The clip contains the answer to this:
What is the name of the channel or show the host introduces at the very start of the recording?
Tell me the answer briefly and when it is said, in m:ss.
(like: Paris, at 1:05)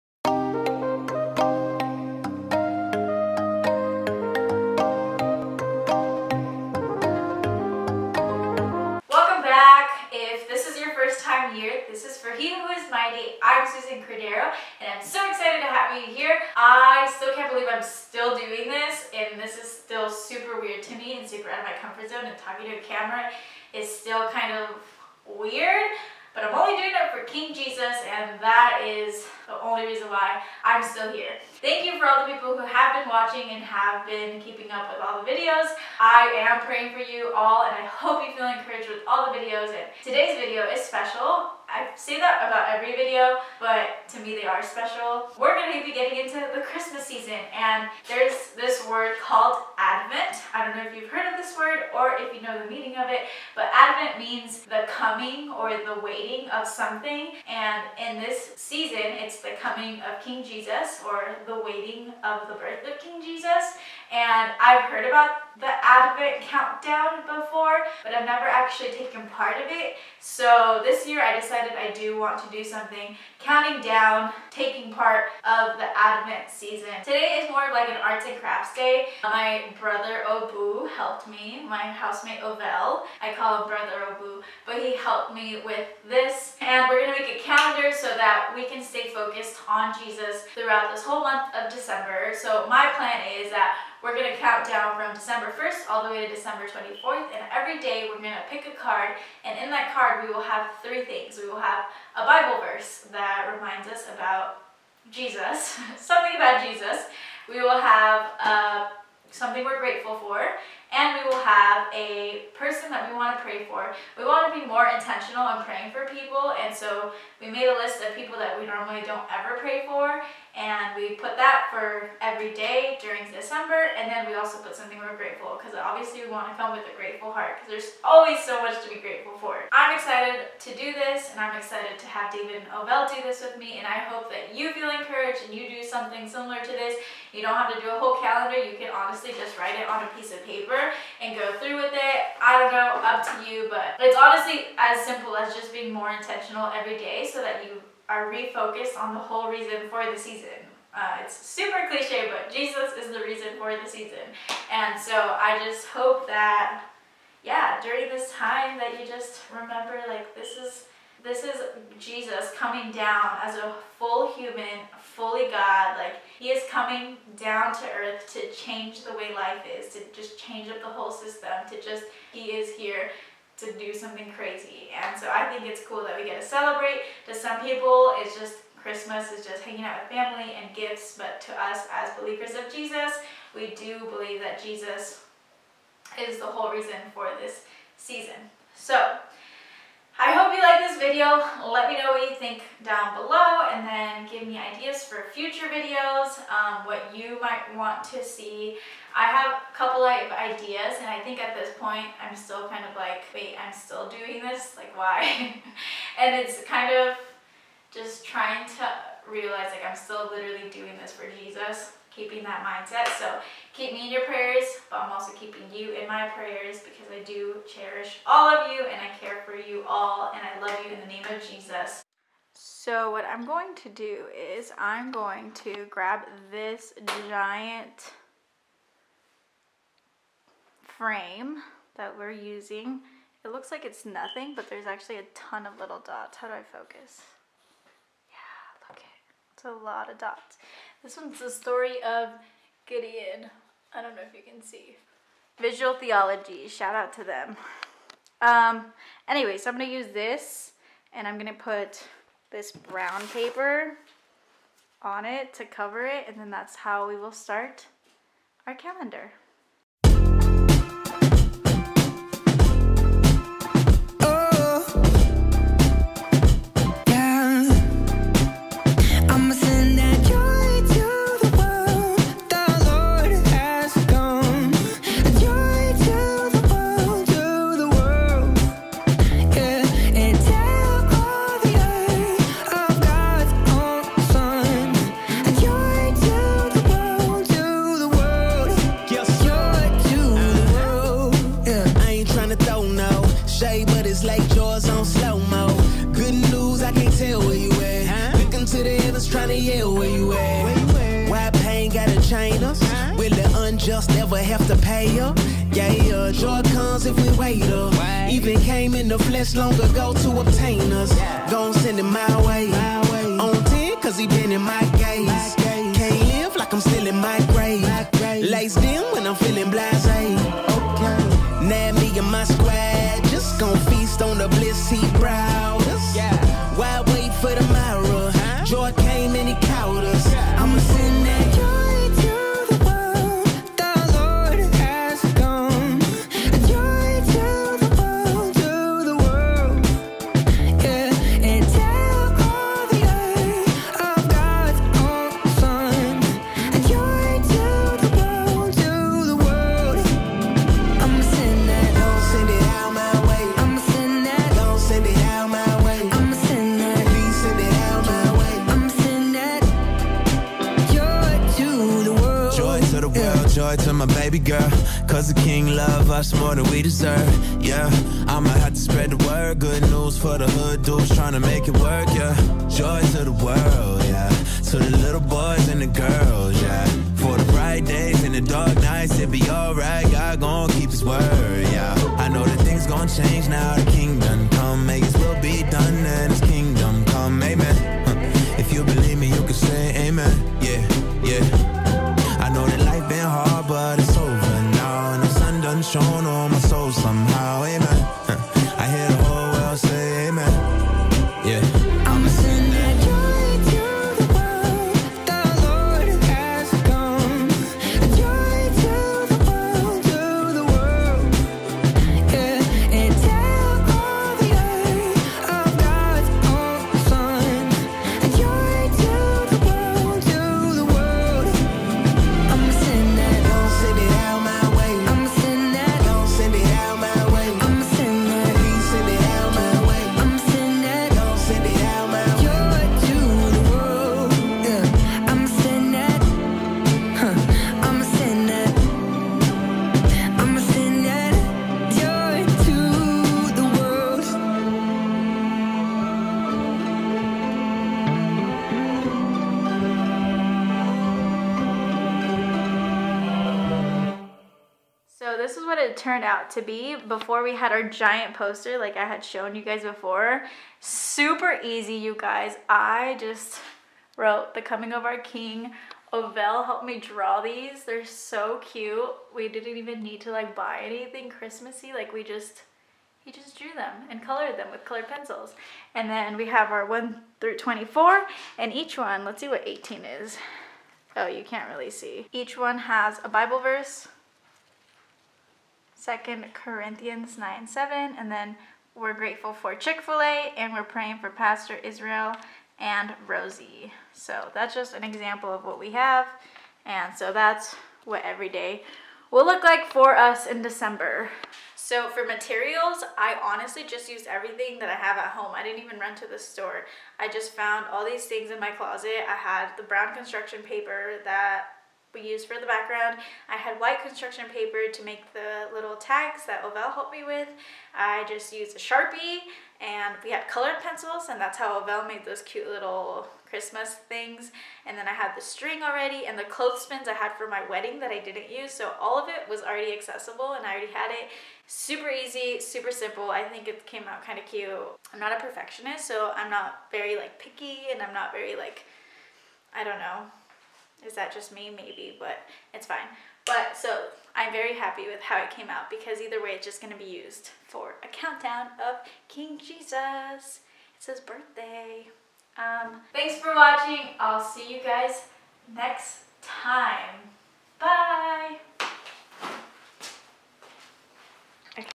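He Who Is Mighty, at 0:12.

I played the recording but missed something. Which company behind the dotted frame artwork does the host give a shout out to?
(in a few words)
Visual Theology.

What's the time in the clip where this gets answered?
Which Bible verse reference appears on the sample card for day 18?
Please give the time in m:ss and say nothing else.
8:06.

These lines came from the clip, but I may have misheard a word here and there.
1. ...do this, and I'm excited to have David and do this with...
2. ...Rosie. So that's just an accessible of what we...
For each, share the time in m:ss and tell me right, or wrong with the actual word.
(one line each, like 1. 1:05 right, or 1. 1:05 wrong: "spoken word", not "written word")
1. 2:10 right
2. 8:13 wrong: "example", not "accessible".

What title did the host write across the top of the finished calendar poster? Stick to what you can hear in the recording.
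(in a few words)
The Coming of Our King.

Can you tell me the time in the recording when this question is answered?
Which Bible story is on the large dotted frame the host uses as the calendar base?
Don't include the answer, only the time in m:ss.
4:02.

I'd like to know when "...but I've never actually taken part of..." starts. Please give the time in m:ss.
1:08.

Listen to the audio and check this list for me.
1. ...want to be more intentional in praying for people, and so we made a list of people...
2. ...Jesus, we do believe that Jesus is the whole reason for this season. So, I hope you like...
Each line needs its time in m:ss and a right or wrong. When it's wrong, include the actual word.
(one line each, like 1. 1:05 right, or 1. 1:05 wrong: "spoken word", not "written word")
1. 1:54 right
2. 3:02 right.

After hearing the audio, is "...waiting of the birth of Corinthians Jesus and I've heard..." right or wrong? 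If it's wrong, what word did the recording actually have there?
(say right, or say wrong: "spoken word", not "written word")
wrong: "King", not "Corinthians".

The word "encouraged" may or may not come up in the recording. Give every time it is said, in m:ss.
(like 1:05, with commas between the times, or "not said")
0:38, 2:14.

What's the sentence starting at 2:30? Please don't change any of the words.
Uh, it's super cliche, but Jesus is the reason for the season.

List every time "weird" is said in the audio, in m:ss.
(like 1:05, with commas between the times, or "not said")
0:20, 0:25.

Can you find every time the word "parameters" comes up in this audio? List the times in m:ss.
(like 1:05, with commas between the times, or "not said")
not said.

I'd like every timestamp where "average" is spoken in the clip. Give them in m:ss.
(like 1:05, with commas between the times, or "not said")
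not said.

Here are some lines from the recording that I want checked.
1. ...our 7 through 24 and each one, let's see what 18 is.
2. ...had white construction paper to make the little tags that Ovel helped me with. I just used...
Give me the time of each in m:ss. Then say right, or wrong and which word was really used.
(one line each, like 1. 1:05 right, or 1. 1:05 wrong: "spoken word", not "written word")
1. 7:56 wrong: "1", not "7"
2. 8:33 right.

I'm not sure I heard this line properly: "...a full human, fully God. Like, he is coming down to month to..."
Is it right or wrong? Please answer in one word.
wrong.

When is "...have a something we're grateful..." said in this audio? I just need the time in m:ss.
1:47.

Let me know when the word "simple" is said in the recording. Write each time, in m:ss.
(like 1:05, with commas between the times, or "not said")
2:25, 8:52.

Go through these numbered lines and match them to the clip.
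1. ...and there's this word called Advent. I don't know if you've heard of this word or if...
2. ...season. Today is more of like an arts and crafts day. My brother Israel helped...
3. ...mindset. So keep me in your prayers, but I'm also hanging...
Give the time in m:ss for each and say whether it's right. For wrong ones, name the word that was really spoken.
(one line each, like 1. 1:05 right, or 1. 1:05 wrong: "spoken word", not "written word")
1. 0:47 right
2. 1:16 wrong: "Obu", not "Israel"
3. 3:32 wrong: "keeping", not "hanging".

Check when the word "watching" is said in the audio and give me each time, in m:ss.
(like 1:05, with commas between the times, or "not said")
0:33, 9:13.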